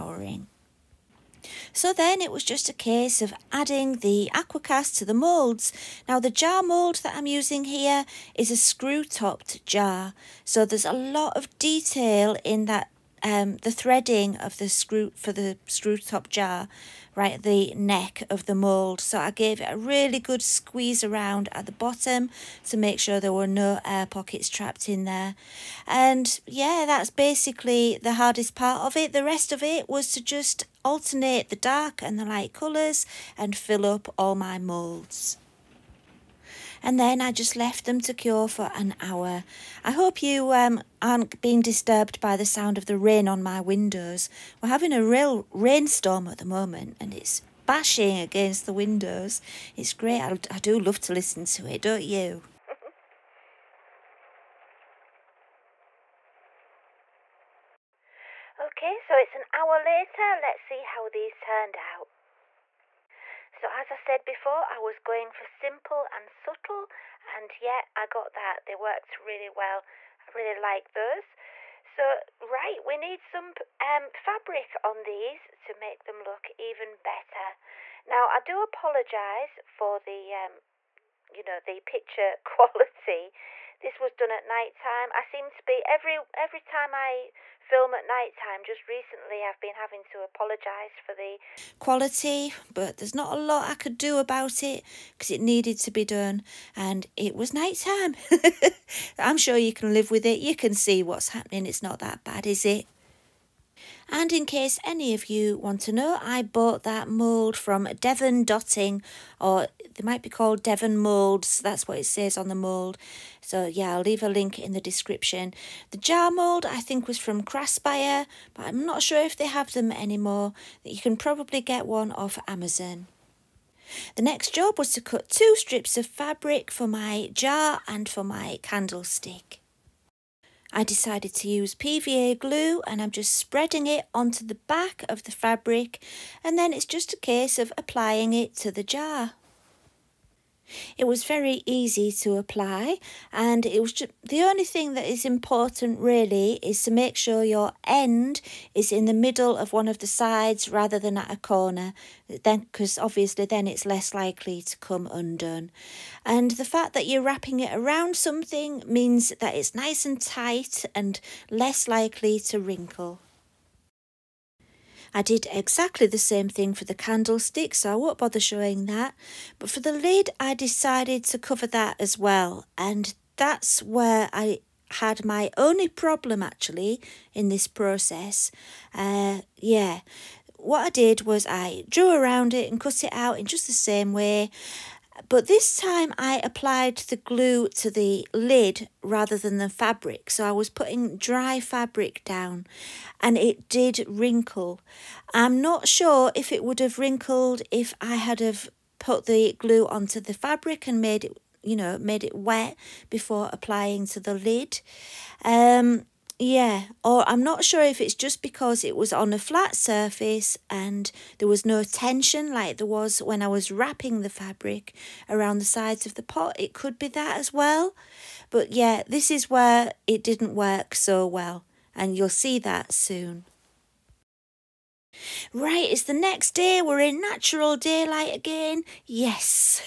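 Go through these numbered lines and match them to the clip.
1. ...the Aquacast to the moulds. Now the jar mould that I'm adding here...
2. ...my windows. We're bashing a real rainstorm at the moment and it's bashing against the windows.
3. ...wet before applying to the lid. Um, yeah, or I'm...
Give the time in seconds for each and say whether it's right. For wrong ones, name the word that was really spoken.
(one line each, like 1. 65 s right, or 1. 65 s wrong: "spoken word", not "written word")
1. 3 s wrong: "using", not "adding"
2. 43 s wrong: "having", not "bashing"
3. 202 s right.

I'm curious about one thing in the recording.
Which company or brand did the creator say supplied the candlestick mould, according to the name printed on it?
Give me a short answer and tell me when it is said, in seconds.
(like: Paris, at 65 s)
Devon Dotting, at 107 s.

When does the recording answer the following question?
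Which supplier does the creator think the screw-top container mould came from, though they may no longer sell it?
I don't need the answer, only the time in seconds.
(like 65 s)
117 s.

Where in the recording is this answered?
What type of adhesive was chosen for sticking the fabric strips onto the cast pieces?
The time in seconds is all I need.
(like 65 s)
131 s.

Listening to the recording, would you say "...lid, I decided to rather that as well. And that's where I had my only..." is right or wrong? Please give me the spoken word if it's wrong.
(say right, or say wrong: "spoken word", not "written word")
wrong: "cover", not "rather".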